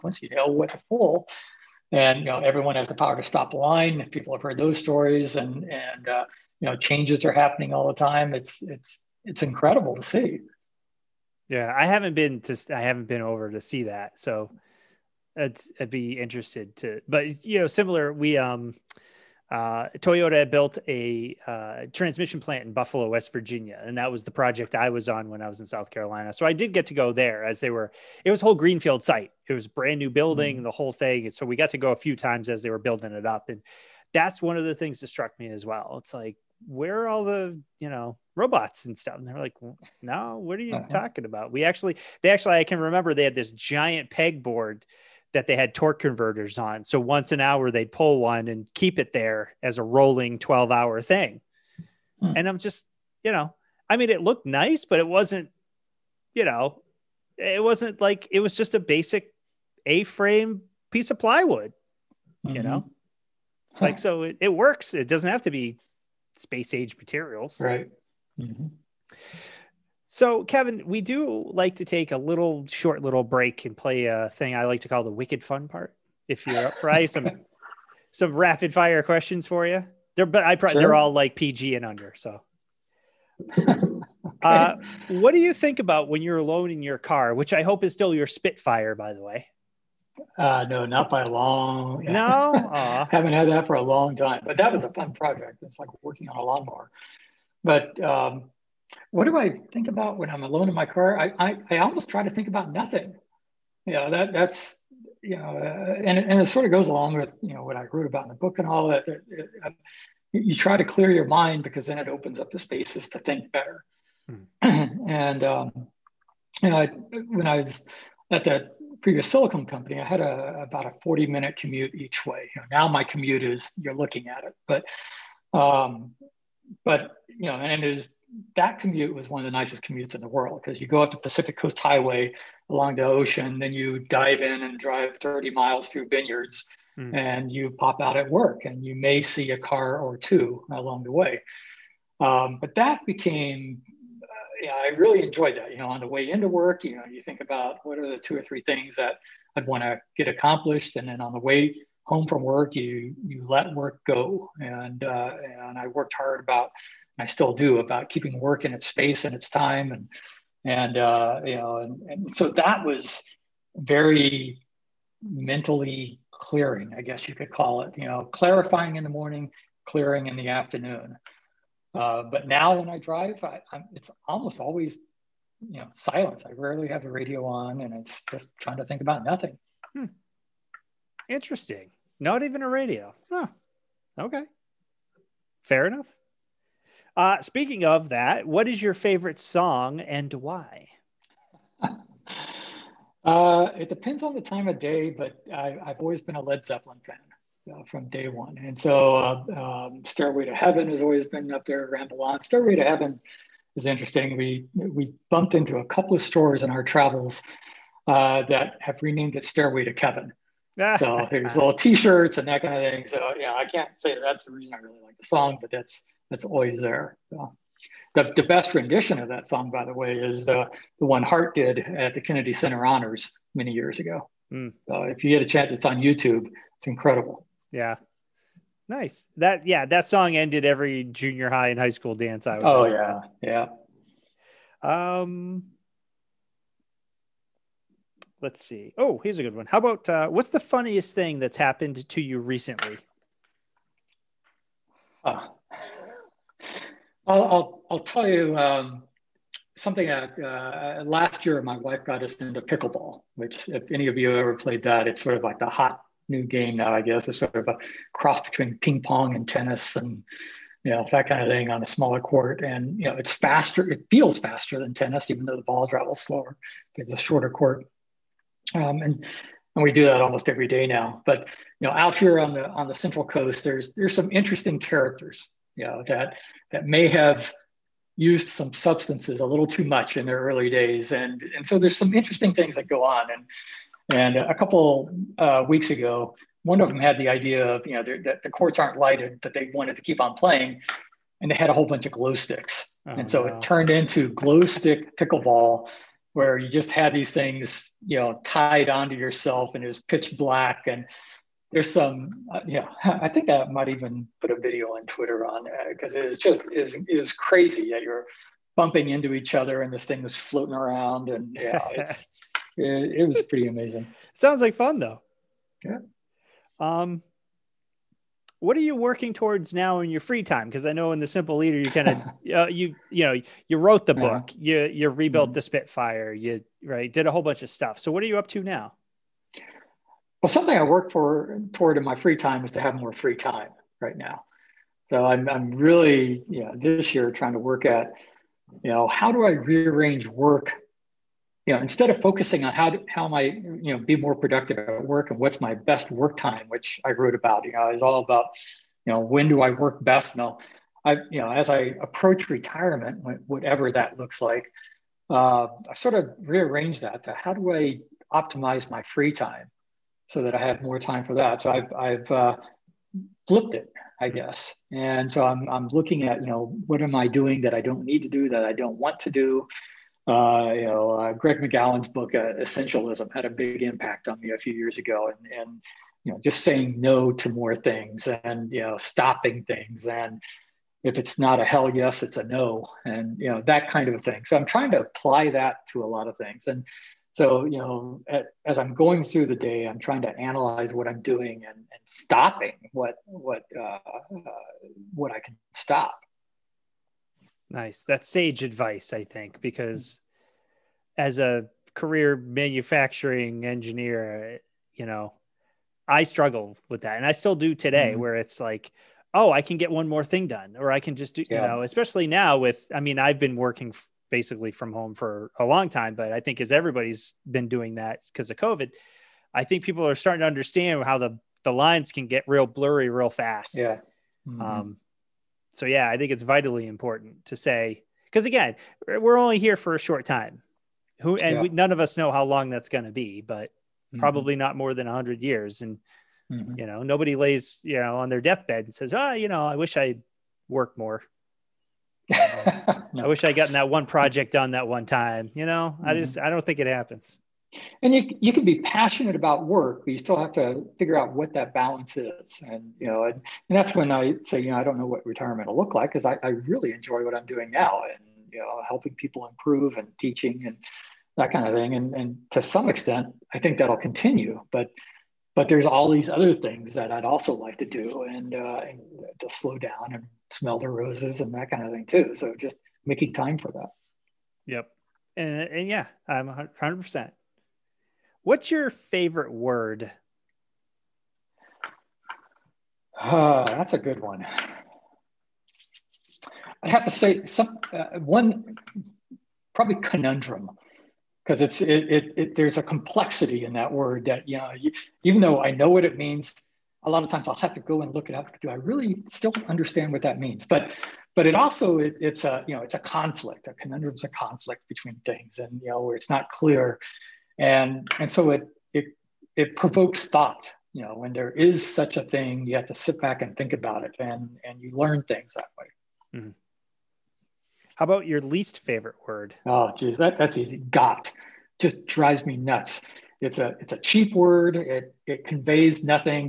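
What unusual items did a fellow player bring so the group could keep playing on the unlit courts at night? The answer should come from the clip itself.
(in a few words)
Glow sticks.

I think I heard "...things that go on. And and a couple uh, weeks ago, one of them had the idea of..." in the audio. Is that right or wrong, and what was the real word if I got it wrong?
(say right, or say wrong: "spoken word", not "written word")
right.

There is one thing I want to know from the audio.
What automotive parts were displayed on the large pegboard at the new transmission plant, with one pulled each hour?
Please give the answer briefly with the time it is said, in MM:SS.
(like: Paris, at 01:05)
Torque converters, at 00:45.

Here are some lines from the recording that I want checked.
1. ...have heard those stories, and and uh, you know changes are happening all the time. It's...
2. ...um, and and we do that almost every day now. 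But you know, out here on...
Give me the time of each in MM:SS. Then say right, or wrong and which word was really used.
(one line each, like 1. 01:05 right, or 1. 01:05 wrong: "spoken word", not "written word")
1. 00:04 right
2. 04:28 right.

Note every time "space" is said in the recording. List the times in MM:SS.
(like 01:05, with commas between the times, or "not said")
01:06, 01:52, 02:38.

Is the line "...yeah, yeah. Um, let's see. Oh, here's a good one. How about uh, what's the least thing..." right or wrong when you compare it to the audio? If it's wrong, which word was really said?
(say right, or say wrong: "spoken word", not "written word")
wrong: "funniest", not "least".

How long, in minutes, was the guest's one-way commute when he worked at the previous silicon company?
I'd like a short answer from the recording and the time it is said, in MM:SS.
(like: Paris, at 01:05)
40 minutes, at 02:01.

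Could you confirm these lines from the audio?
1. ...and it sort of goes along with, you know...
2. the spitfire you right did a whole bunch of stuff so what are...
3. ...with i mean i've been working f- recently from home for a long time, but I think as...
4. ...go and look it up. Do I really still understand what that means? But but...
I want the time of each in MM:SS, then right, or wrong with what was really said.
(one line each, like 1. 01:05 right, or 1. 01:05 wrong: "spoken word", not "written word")
1. 01:46 right
2. 05:25 right
3. 06:52 wrong: "basically", not "recently"
4. 08:17 right.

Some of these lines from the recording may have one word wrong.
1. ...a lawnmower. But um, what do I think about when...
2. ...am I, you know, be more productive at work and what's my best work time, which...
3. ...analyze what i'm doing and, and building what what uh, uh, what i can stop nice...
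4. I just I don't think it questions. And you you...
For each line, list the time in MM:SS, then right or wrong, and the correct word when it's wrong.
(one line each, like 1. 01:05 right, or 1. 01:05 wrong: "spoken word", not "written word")
1. 01:36 right
2. 05:43 right
3. 06:30 wrong: "stopping", not "building"
4. 07:26 wrong: "happens", not "questions".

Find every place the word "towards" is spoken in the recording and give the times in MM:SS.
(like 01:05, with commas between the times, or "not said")
05:19, 05:31.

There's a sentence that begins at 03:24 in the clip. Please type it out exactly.
We, we bumped into a couple of stores in our travels uh, that have renamed it Stairway to Kevin.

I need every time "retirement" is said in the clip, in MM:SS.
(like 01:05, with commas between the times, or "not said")
05:52, 07:35.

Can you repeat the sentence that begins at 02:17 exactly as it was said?
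and you pop out at work, and you may see a car or two along the way.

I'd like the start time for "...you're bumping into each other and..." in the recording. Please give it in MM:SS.
05:08.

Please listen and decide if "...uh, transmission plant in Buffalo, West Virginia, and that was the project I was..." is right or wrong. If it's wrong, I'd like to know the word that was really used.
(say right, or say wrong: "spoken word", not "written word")
right.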